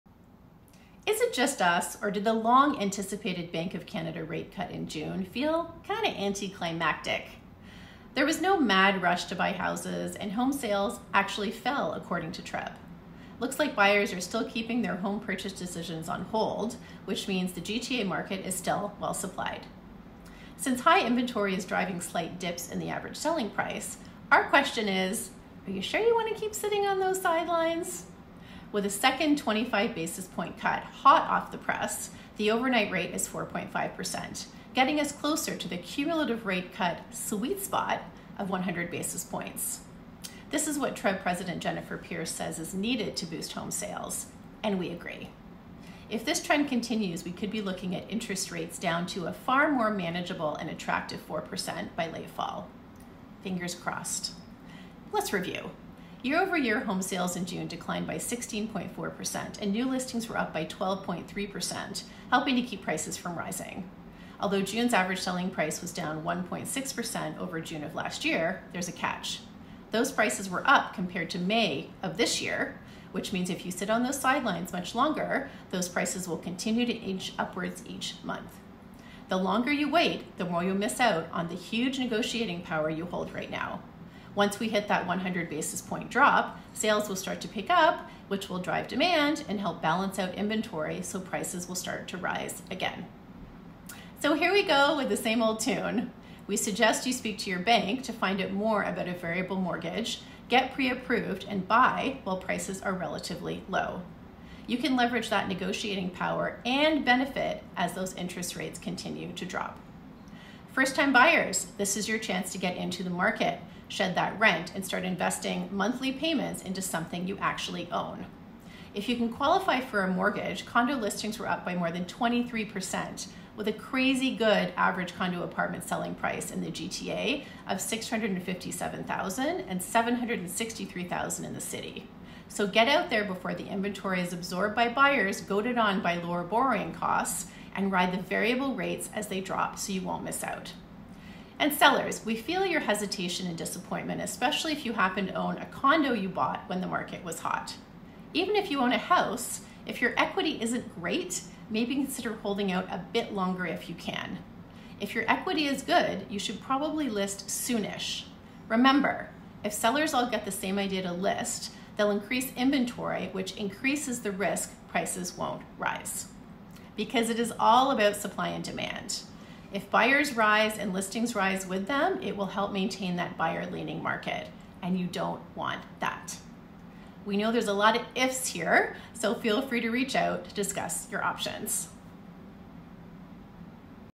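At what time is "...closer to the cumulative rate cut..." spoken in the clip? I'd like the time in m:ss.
0:35.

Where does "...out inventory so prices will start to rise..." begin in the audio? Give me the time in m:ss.
1:30.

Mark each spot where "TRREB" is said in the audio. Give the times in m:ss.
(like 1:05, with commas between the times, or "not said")
0:12, 0:40.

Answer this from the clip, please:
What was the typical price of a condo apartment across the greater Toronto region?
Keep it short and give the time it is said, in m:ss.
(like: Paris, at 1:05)
657,000, at 2:07.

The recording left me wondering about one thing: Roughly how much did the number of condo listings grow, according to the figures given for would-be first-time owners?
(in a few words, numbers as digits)
more than 23%.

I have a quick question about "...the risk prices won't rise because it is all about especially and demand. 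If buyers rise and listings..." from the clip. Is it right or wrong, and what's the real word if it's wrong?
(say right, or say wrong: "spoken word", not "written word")
wrong: "supply", not "especially".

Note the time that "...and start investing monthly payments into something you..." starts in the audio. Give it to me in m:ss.
1:54.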